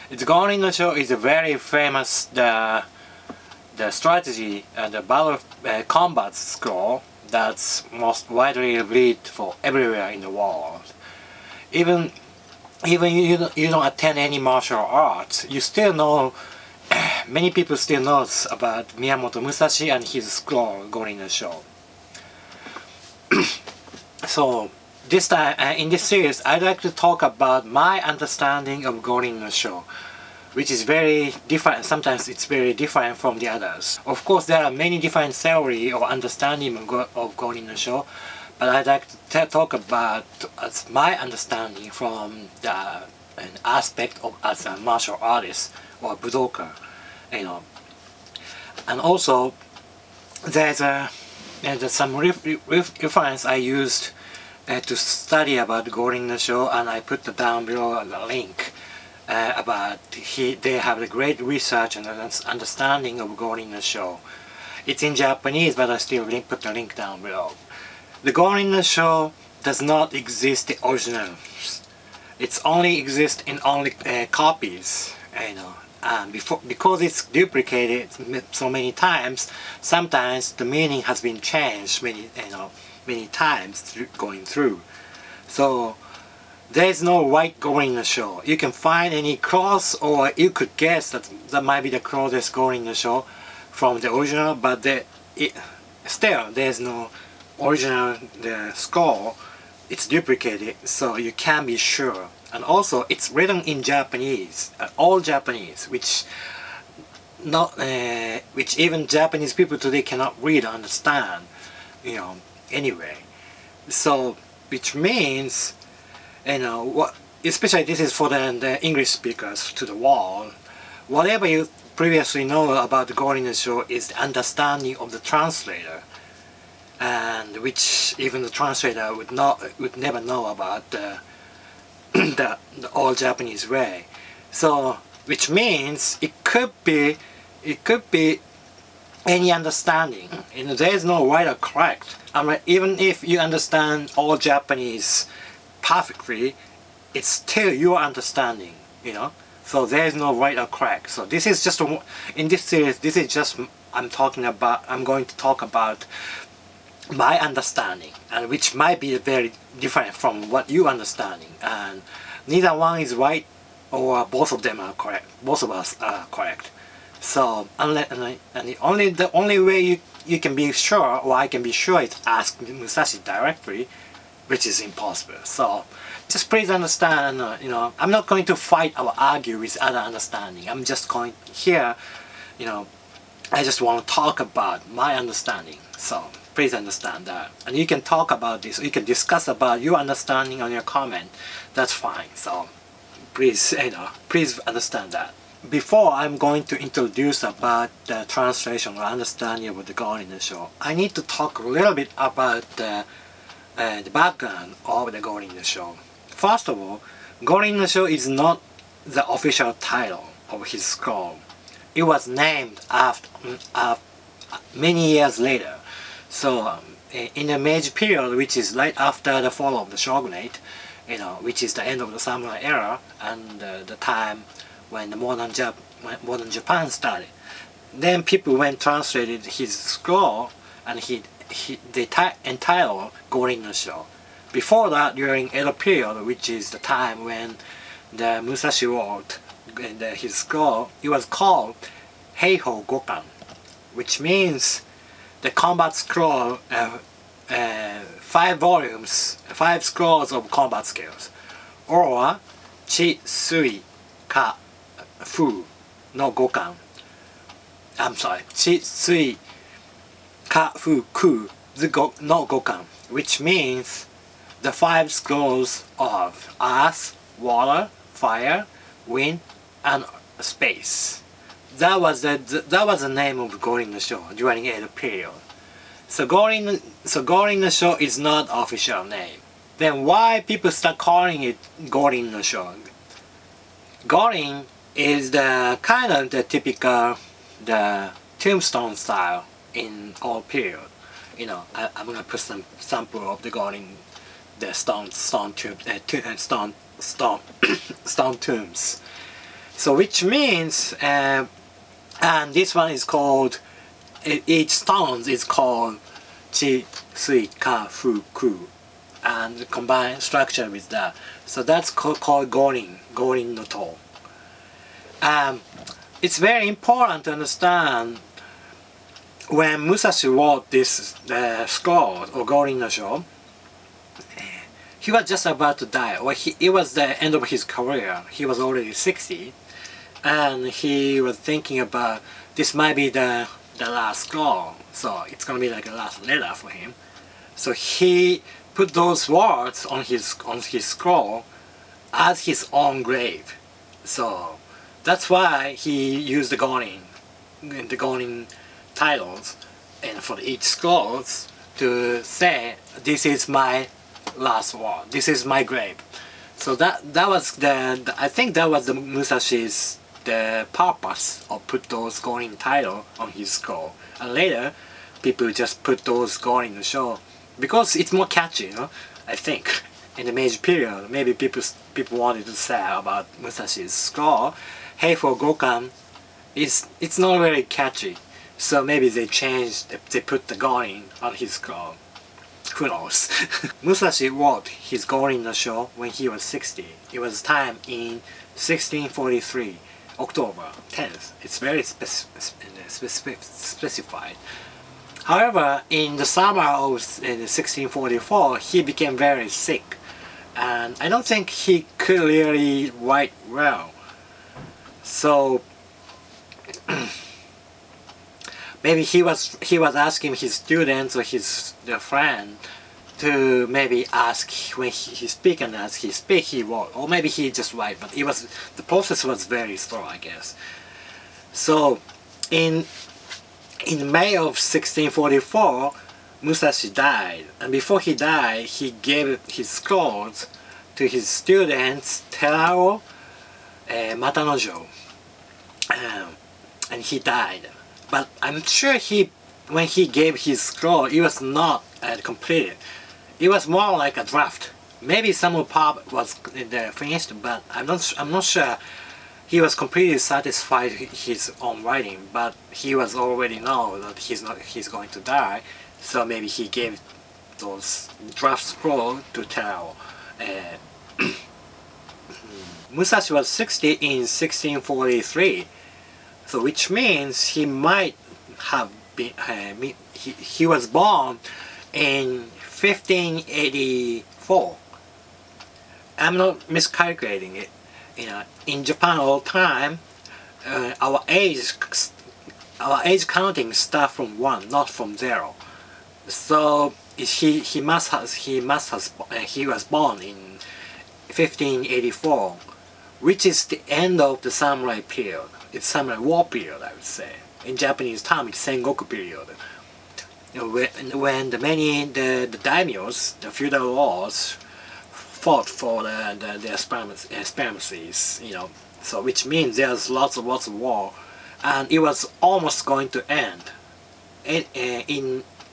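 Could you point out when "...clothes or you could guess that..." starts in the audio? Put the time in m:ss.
1:29.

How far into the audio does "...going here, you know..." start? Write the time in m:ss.
3:01.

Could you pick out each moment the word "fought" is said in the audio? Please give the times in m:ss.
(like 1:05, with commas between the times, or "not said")
8:25.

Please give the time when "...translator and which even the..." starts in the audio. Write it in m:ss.
2:05.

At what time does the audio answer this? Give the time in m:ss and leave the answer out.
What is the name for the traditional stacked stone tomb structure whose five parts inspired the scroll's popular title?
5:12.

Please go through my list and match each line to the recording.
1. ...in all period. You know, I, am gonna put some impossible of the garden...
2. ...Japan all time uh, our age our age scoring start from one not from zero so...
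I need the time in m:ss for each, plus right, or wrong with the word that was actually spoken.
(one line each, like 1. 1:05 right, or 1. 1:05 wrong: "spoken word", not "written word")
1. 4:49 wrong: "sample", not "impossible"
2. 7:58 wrong: "counting", not "scoring".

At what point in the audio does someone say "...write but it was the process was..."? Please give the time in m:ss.
6:57.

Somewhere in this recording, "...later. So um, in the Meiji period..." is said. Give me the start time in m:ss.
3:35.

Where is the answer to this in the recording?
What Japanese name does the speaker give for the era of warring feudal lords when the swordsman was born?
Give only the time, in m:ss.
8:18.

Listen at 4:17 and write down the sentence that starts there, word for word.
I'm sorry, Chi Sui kafuku no gokan, which means the five schools of earth, water, fire, wind, and space.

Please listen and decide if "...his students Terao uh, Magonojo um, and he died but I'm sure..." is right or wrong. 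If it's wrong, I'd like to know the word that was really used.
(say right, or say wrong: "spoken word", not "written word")
right.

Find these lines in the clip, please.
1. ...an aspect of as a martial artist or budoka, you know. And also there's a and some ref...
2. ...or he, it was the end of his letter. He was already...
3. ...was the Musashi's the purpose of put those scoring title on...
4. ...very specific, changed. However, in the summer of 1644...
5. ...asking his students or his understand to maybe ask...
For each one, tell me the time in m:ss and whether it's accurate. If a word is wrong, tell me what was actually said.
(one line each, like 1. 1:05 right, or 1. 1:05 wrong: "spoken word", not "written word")
1. 0:43 right
2. 5:26 wrong: "career", not "letter"
3. 5:58 right
4. 6:31 wrong: "specified", not "changed"
5. 6:49 wrong: "friend", not "understand".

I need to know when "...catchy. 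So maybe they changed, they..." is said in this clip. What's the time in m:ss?
6:17.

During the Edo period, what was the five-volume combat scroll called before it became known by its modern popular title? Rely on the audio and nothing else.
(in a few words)
Heiho Gokan.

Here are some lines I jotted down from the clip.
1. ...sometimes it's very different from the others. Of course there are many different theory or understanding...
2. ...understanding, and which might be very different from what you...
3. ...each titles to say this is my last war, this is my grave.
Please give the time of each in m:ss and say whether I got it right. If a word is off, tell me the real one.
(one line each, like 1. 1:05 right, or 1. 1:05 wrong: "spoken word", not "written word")
1. 0:31 right
2. 2:37 right
3. 5:50 wrong: "scores", not "titles".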